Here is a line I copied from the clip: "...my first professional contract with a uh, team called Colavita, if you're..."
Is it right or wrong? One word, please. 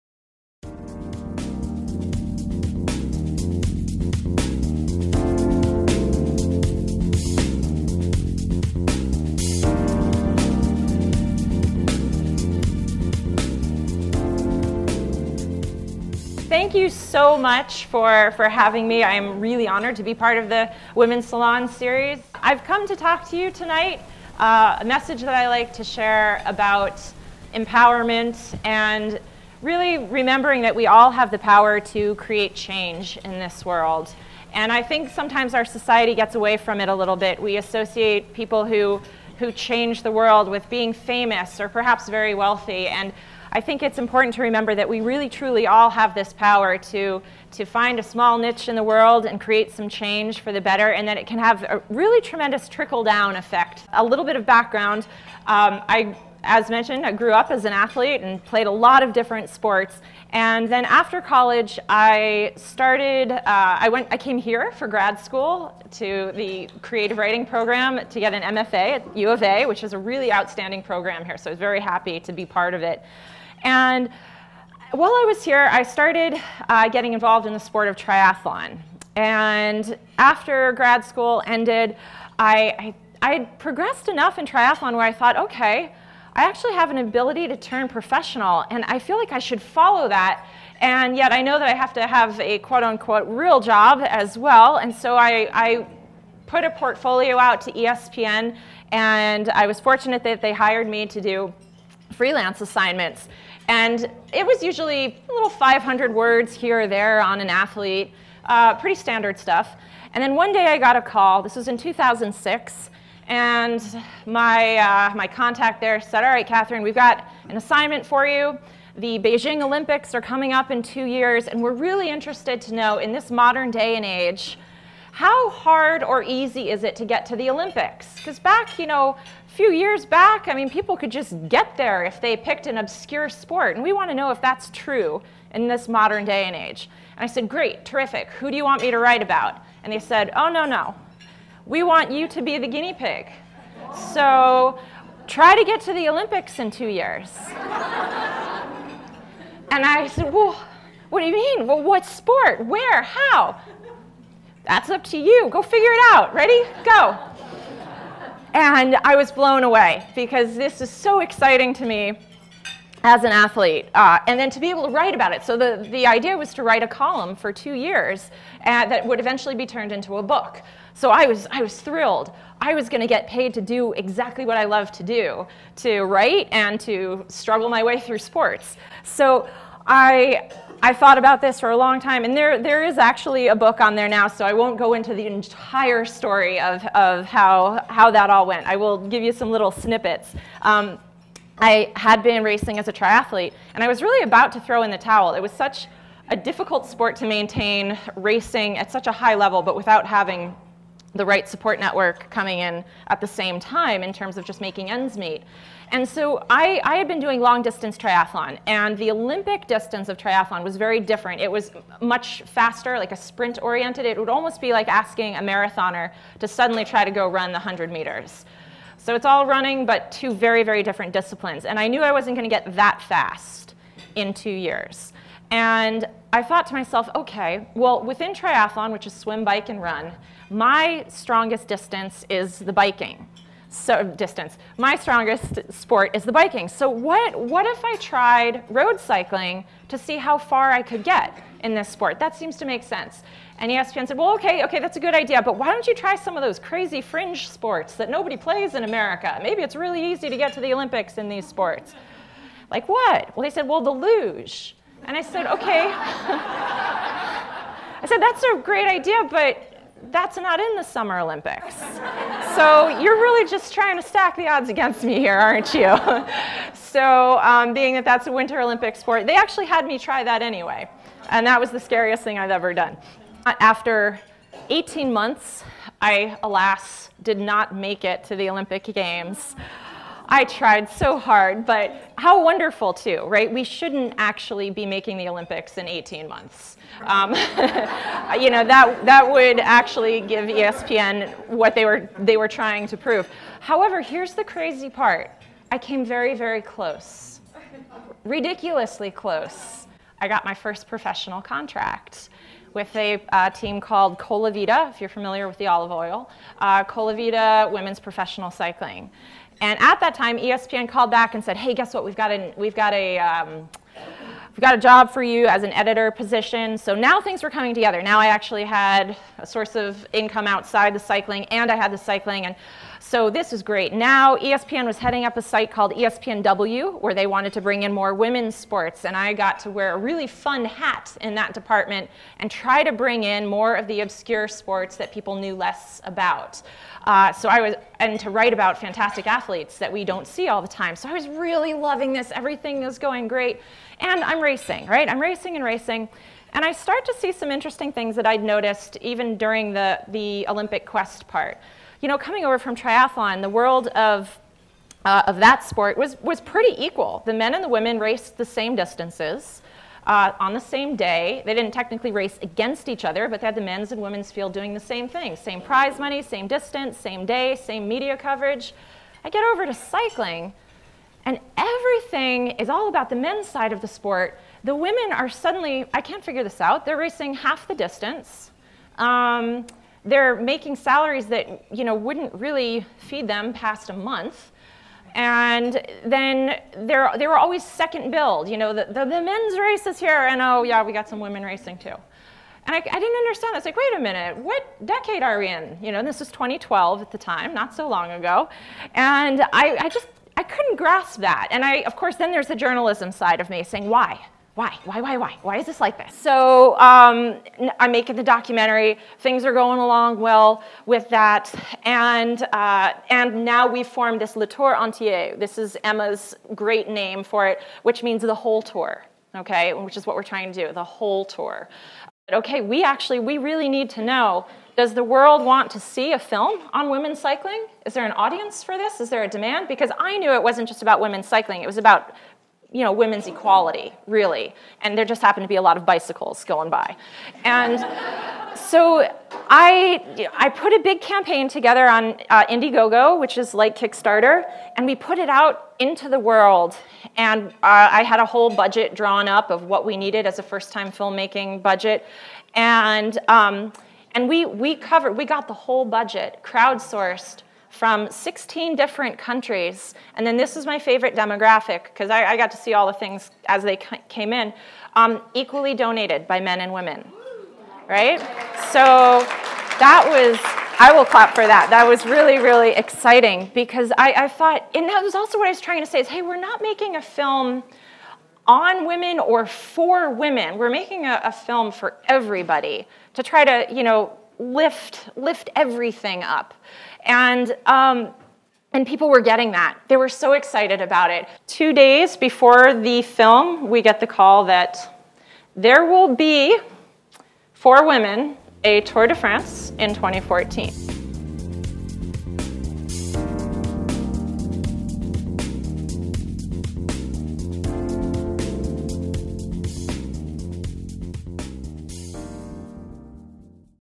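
right.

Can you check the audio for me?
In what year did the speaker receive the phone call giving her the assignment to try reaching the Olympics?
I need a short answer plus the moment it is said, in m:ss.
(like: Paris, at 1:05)
2006, at 1:51.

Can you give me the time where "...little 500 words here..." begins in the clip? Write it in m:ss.
1:45.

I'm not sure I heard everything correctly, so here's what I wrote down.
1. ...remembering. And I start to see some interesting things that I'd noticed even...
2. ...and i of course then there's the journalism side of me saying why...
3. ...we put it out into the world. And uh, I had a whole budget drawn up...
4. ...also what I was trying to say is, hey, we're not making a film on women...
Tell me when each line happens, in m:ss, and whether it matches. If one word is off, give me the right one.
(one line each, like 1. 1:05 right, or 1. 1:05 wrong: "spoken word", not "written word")
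1. 5:45 wrong: "racing", not "remembering"
2. 6:41 right
3. 7:24 right
4. 7:55 right.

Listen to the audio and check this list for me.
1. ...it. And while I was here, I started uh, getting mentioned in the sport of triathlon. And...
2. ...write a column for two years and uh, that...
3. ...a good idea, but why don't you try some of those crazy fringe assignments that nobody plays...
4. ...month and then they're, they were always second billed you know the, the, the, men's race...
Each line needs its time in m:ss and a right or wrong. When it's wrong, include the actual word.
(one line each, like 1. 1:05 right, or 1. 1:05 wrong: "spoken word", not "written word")
1. 1:12 wrong: "involved", not "mentioned"
2. 2:46 right
3. 4:04 wrong: "sports", not "assignments"
4. 6:23 right.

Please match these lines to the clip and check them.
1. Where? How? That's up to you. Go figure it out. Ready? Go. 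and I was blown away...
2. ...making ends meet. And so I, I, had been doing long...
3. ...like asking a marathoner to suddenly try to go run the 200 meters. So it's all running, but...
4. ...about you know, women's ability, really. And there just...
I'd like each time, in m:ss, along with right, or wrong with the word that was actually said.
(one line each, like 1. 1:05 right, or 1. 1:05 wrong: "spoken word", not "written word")
1. 2:32 right
2. 3:24 right
3. 3:34 wrong: "100", not "200"
4. 7:11 wrong: "equality", not "ability".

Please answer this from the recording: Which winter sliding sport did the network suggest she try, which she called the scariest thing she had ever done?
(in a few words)
Luge.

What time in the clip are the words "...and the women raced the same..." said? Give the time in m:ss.
5:57.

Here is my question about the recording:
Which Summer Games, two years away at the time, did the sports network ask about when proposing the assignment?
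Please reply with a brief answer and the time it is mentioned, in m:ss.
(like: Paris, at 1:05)
Beijing Olympics, at 1:59.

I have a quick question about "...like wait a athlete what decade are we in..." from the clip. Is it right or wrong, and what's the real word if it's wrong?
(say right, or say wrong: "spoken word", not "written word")
wrong: "minute", not "athlete".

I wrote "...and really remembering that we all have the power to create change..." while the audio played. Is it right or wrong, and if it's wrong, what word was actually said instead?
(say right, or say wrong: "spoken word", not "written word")
right.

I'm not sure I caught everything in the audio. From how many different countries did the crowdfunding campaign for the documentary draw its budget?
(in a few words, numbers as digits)
16.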